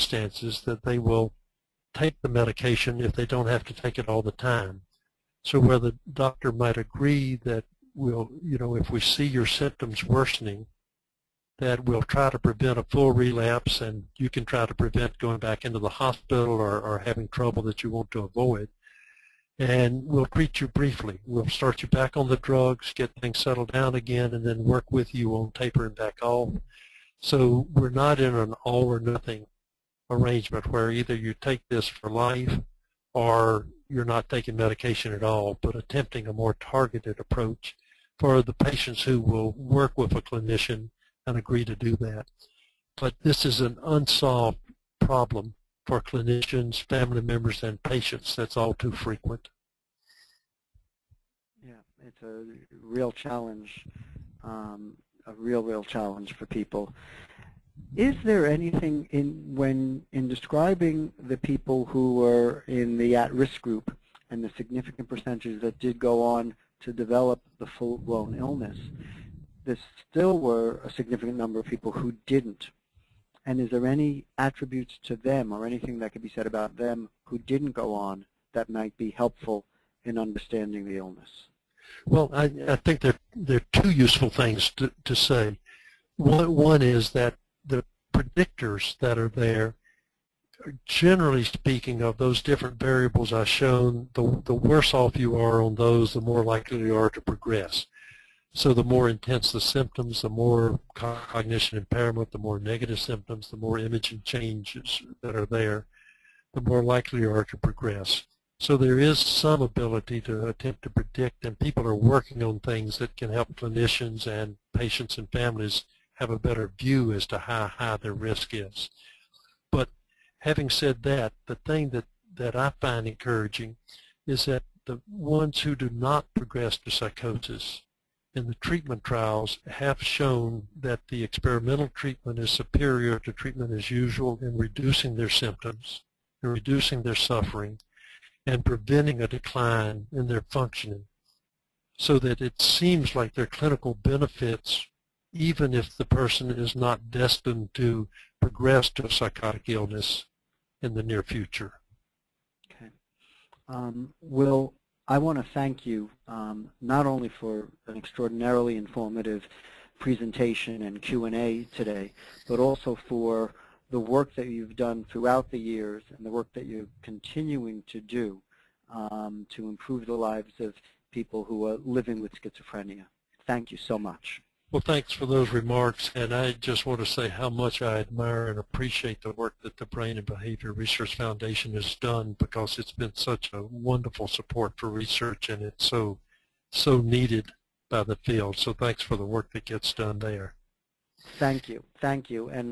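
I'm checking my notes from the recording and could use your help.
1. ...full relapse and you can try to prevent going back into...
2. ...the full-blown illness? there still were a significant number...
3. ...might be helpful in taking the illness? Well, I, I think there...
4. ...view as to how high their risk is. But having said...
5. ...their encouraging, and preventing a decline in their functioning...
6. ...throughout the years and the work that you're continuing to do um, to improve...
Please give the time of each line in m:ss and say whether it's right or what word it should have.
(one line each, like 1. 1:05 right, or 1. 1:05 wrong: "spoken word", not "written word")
1. 0:12 right
2. 1:07 right
3. 1:18 wrong: "understanding", not "taking"
4. 1:56 right
5. 2:17 wrong: "suffering", not "encouraging"
6. 2:45 right.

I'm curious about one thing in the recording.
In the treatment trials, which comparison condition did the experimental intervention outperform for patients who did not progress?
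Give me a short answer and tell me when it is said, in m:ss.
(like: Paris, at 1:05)
Treatment as usual, at 2:13.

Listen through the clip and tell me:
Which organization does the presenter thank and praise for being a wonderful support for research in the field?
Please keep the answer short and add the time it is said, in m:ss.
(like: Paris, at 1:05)
Brain and Behavior Research Foundation, at 2:59.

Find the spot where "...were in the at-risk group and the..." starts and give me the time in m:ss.
1:02.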